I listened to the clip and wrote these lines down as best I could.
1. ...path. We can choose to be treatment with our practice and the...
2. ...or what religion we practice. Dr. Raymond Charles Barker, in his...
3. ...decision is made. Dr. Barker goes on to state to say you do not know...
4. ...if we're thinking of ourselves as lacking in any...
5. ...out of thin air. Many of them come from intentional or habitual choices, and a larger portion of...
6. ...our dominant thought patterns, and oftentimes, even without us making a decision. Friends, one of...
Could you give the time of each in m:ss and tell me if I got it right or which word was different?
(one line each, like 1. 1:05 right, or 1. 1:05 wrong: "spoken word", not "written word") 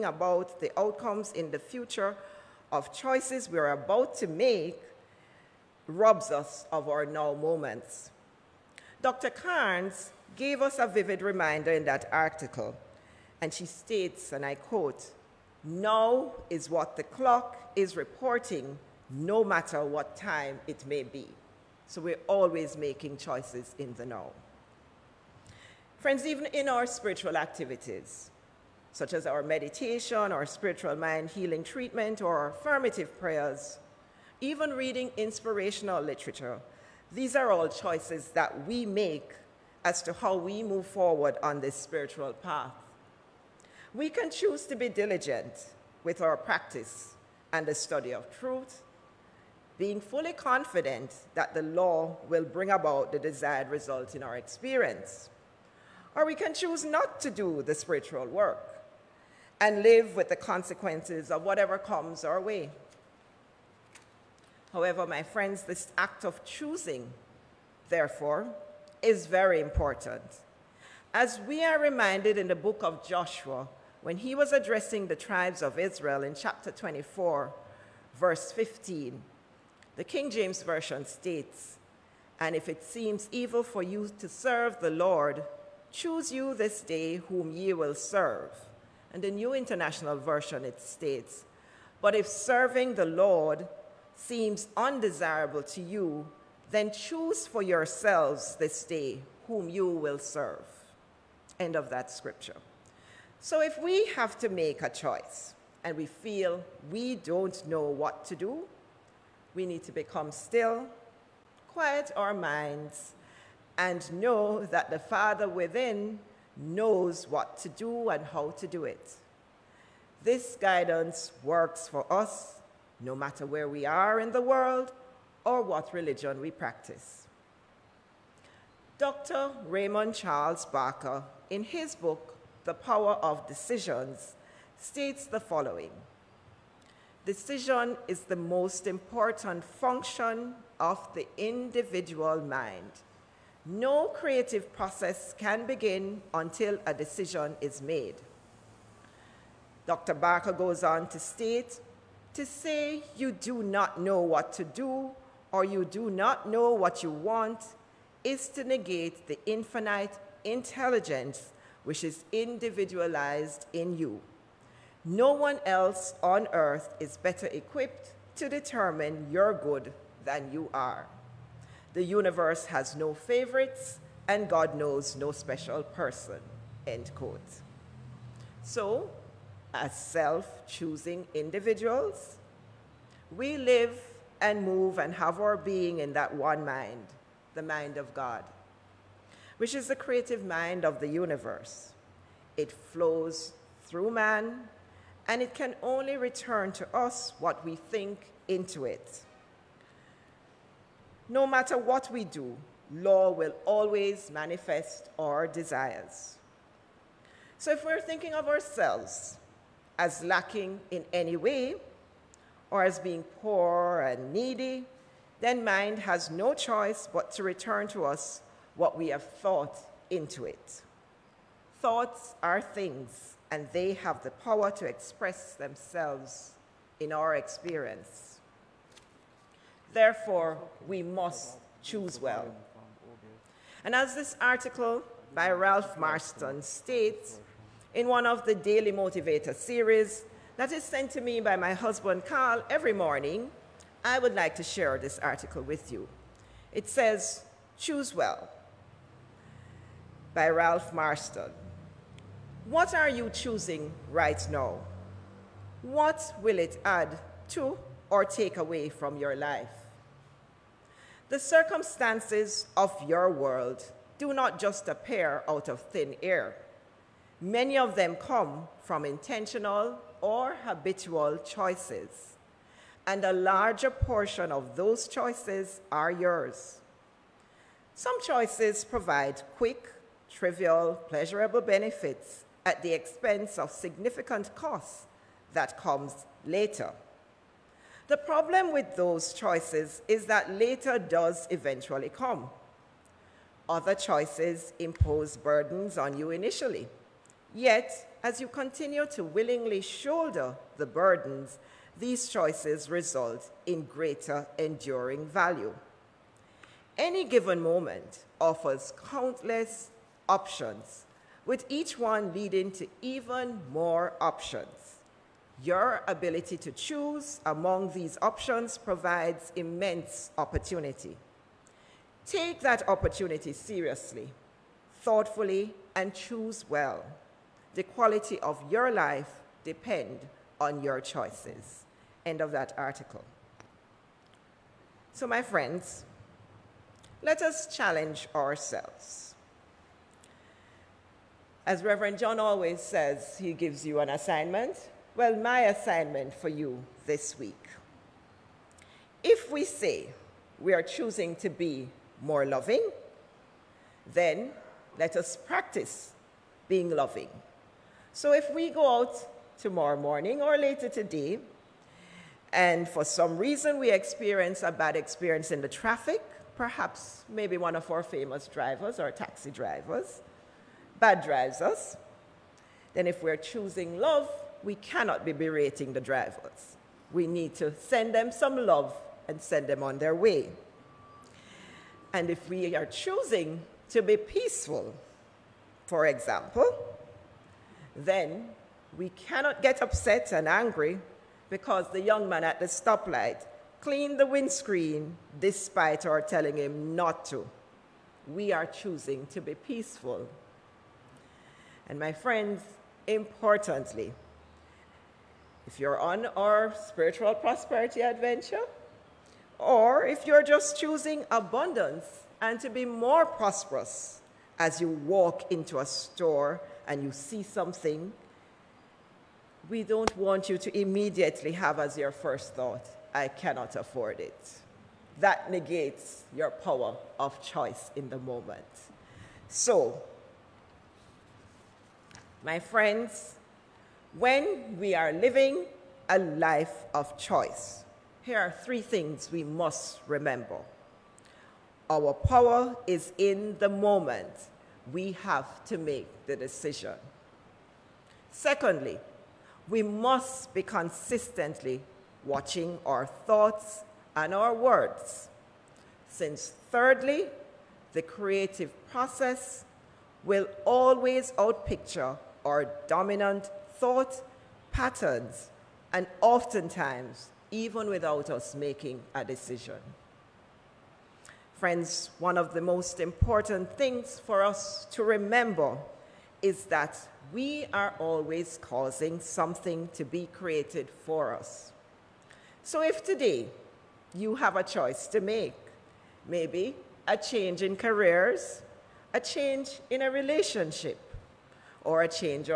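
1. 0:42 wrong: "diligent", not "treatment"
2. 2:05 right
3. 2:26 right
4. 3:27 right
5. 4:25 right
6. 7:42 right.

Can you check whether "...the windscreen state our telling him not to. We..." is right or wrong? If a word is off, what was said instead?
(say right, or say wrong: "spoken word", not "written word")
wrong: "despite", not "state".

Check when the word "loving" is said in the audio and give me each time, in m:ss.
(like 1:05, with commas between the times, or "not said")
5:52, 5:56.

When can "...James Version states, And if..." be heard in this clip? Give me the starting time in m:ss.
1:20.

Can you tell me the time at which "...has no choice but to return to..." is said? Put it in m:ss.
3:35.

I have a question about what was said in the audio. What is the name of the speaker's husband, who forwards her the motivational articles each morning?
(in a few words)
Carl.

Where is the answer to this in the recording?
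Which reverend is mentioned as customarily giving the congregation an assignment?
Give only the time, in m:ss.
5:41.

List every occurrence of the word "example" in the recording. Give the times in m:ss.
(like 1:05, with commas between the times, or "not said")
6:26.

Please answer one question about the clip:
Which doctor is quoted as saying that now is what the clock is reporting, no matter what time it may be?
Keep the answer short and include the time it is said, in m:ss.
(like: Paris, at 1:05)
Dr. Carnes, at 0:09.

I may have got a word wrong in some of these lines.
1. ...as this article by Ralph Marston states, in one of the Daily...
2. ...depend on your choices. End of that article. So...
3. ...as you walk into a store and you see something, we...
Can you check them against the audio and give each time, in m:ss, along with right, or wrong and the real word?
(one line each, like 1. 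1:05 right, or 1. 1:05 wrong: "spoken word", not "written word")
1. 3:53 right
2. 5:29 right
3. 6:54 right.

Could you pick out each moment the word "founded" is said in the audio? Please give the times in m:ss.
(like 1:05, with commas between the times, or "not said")
not said.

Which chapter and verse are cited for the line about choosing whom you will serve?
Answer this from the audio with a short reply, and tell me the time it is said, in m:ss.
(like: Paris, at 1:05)
Chapter 24, verse 15, at 1:16.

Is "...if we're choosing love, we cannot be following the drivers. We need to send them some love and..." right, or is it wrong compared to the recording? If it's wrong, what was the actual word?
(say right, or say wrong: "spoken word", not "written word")
wrong: "berating", not "following".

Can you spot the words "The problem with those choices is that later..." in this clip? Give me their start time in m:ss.
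4:48.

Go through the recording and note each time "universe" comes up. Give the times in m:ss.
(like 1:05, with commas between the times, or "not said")
2:52, 3:11.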